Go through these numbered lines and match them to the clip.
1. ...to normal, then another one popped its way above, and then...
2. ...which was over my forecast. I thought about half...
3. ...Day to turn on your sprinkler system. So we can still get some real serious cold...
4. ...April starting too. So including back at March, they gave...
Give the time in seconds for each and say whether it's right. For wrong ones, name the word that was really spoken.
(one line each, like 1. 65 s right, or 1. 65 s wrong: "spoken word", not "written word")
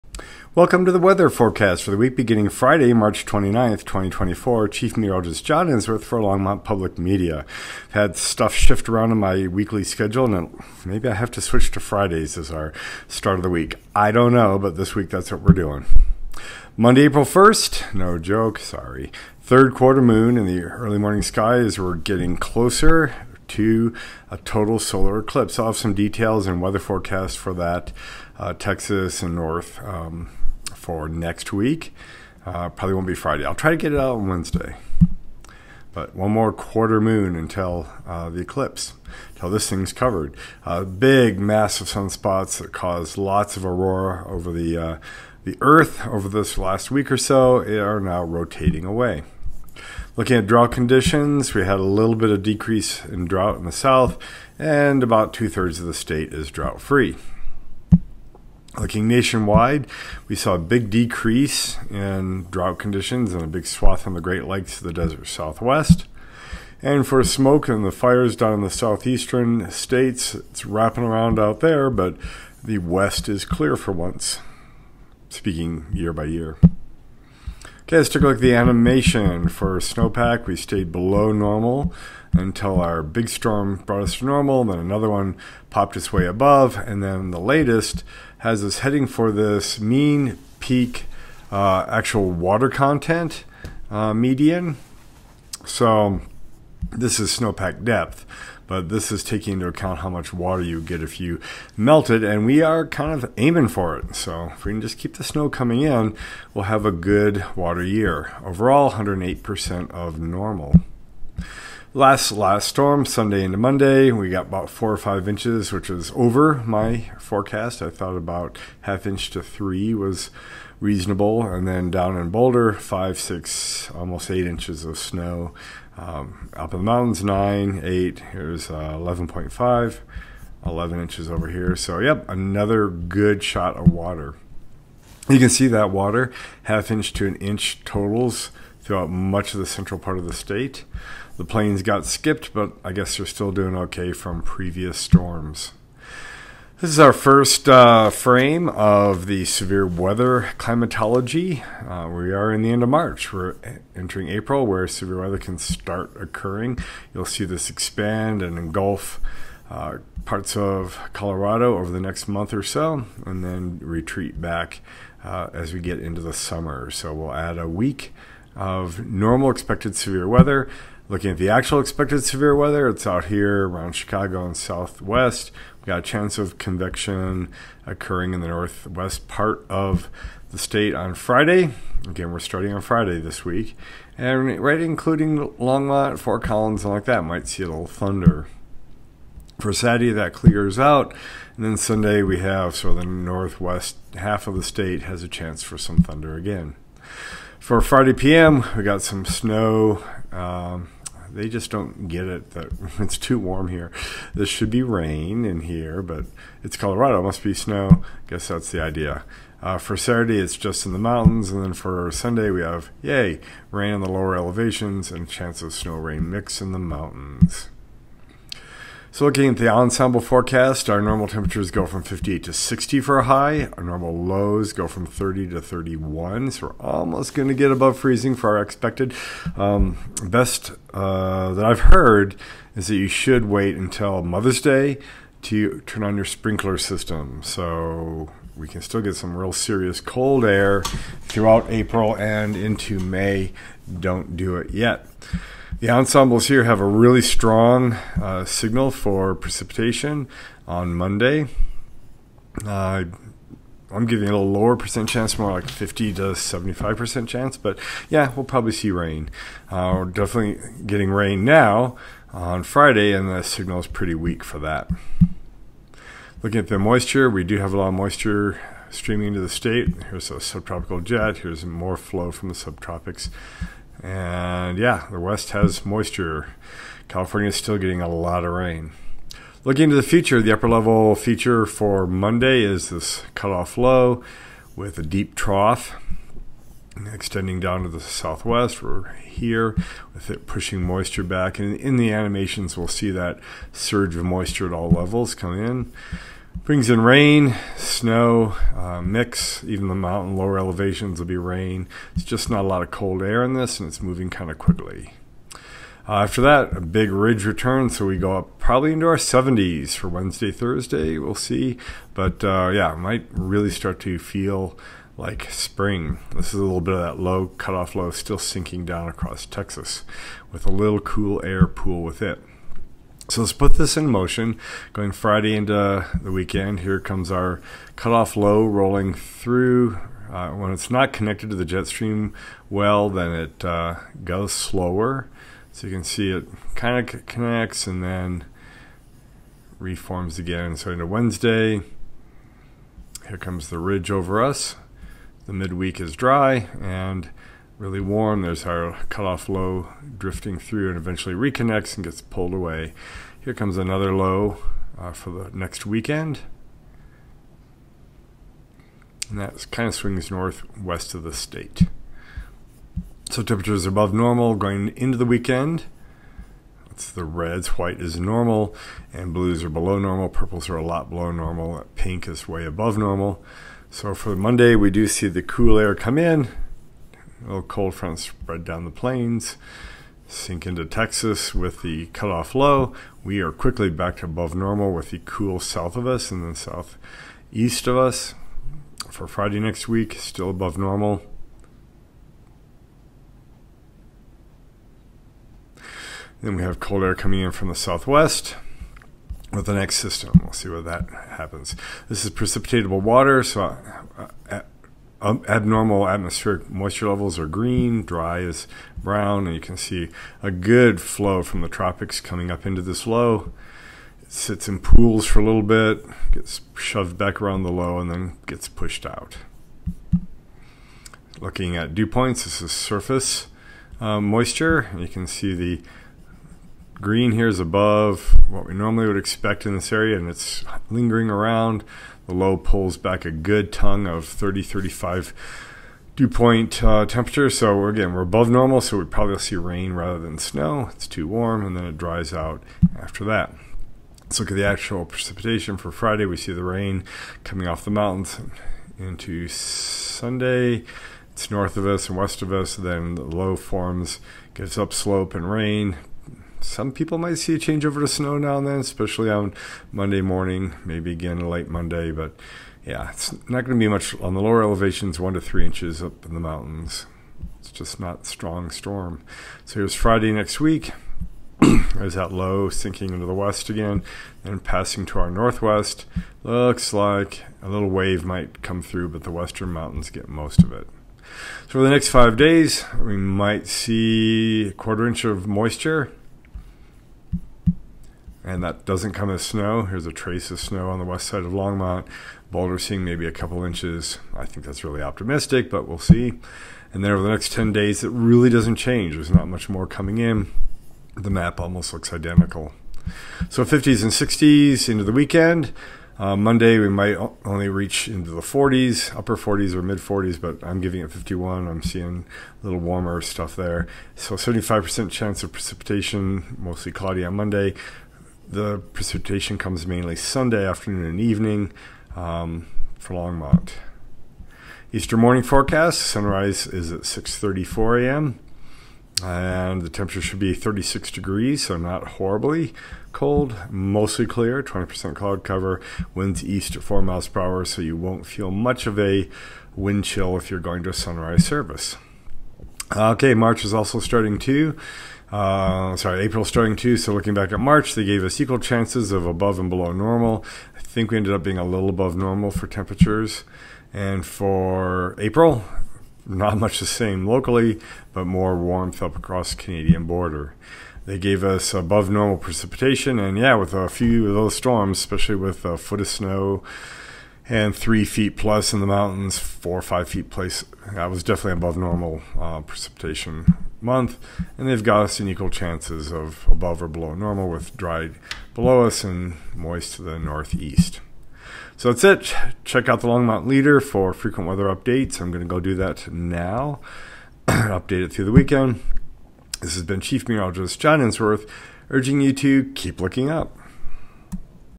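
1. 84 s right
2. 115 s right
3. 234 s right
4. 546 s wrong: "looking", not "including".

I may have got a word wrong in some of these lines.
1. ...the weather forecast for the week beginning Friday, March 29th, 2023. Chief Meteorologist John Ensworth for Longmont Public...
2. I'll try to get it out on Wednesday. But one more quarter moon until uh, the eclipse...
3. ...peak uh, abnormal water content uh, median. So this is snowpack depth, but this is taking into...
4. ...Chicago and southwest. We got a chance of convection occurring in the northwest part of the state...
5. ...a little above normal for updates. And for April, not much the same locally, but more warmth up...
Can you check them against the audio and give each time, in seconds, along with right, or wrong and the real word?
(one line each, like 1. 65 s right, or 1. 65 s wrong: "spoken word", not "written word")
1. 0 s wrong: "2024", not "2023"
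2. 33 s right
3. 90 s wrong: "actual", not "abnormal"
4. 173 s right
5. 551 s wrong: "temperatures", not "updates".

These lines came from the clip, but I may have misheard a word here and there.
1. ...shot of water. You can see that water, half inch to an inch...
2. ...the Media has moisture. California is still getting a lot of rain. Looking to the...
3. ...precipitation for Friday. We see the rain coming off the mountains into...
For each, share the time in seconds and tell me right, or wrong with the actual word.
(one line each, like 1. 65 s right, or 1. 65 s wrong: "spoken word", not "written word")
1. 133 s right
2. 275 s wrong: "West", not "Media"
3. 445 s right.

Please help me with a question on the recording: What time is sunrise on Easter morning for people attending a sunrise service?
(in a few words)
6:34 a.m.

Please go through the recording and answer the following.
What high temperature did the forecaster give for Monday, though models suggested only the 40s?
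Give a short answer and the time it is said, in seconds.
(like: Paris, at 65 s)
51, at 510 s.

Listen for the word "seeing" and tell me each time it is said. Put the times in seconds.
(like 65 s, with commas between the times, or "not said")
492 s, 511 s.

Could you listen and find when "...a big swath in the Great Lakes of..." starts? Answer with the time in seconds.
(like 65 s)
63 s.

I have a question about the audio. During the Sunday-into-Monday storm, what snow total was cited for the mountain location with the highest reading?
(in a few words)
11.5 inches.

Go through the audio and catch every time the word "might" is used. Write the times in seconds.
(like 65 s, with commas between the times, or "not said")
187 s, 312 s, 457 s, 478 s, 483 s, 506 s.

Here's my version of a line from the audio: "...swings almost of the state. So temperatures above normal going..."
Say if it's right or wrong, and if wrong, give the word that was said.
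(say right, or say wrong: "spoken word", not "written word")
wrong: "northwest", not "almost".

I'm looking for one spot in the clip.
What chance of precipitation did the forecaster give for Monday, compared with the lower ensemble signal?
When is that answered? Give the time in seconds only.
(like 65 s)
255 s.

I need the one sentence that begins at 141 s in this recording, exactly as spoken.
The plains got skipped, but I guess they're still doing okay from previous storms.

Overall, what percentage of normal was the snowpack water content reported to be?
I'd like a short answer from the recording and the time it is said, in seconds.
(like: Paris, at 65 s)
108%, at 108 s.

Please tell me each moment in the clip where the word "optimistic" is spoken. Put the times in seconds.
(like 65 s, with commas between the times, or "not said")
495 s.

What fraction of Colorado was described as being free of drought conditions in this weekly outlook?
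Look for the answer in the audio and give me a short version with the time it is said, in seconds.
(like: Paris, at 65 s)
two thirds, at 55 s.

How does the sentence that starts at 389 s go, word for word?
For Friday next week, still above normal.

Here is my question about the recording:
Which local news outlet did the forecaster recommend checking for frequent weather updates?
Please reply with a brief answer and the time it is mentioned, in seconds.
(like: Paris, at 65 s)
Longmont Leader, at 583 s.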